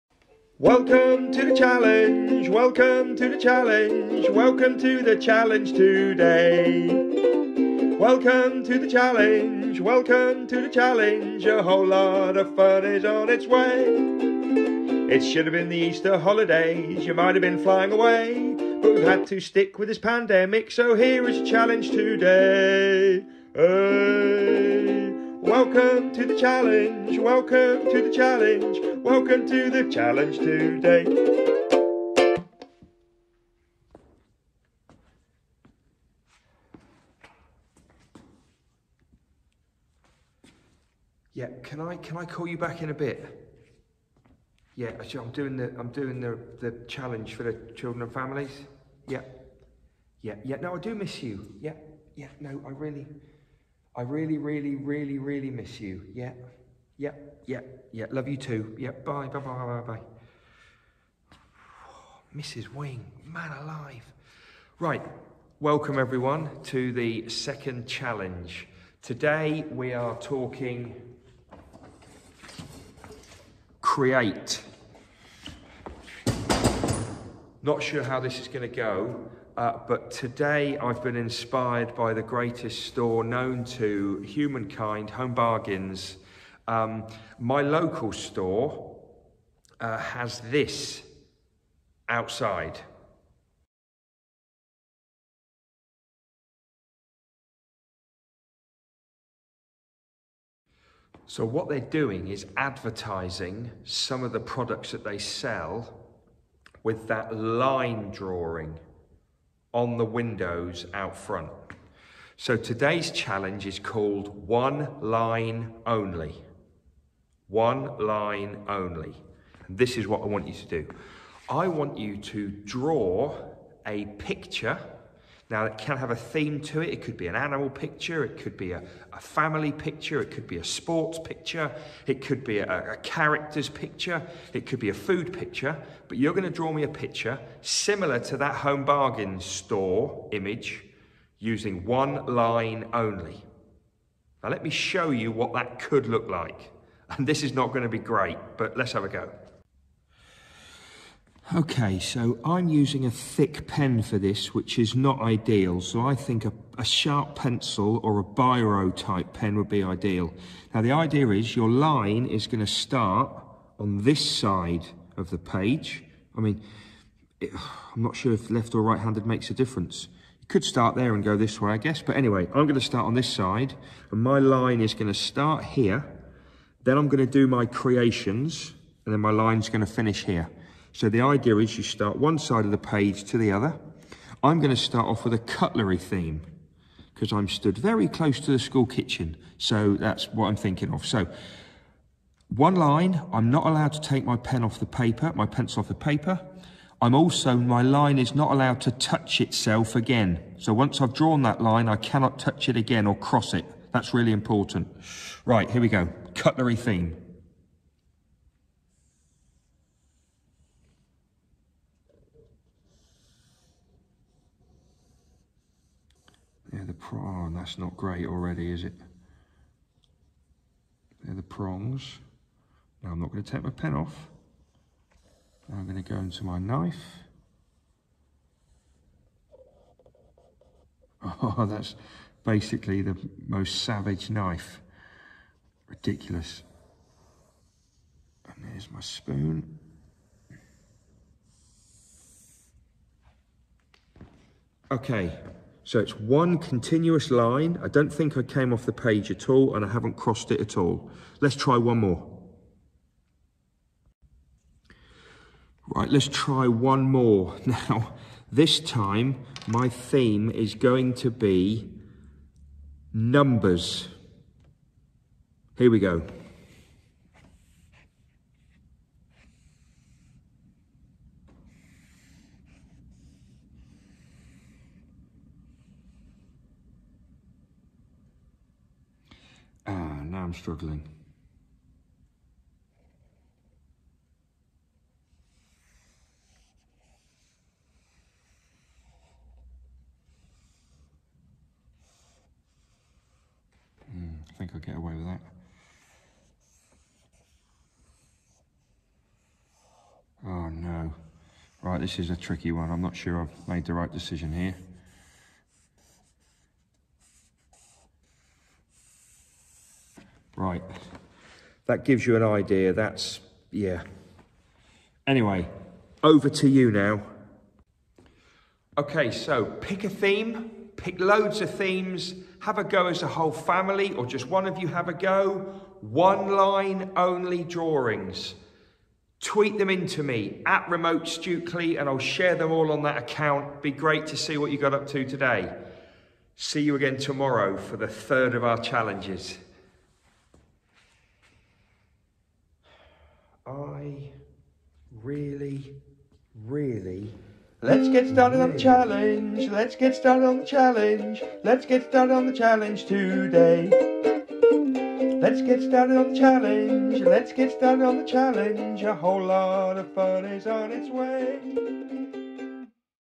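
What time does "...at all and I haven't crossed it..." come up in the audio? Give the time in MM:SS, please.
04:09.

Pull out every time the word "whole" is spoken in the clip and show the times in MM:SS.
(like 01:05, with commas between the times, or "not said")
00:11, 05:23, 05:59.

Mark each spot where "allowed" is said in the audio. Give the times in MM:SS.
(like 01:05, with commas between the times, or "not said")
03:13, 03:18.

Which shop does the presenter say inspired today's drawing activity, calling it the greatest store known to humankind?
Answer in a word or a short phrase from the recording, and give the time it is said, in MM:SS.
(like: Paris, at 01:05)
Home Bargains, at 01:25.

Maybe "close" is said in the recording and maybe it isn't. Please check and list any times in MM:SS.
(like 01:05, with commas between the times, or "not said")
03:08.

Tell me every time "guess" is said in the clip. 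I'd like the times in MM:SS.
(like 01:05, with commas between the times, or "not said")
02:51.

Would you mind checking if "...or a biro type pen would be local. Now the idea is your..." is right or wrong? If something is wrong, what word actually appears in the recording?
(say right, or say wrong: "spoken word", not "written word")
wrong: "ideal", not "local".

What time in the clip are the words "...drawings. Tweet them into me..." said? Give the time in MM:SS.
05:27.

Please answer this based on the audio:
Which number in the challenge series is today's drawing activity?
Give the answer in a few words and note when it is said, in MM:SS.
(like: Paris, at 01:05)
Second, at 01:07.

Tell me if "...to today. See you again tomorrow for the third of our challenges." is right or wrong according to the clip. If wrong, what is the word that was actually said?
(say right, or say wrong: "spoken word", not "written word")
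right.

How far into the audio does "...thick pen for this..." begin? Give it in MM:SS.
02:33.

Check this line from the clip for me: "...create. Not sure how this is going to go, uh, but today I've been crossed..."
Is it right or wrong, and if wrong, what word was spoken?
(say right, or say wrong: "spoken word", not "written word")
wrong: "inspired", not "crossed".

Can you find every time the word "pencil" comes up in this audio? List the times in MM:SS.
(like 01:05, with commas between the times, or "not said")
02:37, 03:15.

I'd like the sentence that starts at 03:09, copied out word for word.
So that's what I'm thinking of.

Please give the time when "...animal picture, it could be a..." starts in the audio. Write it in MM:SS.
02:07.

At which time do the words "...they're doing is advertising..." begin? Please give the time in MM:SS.
01:41.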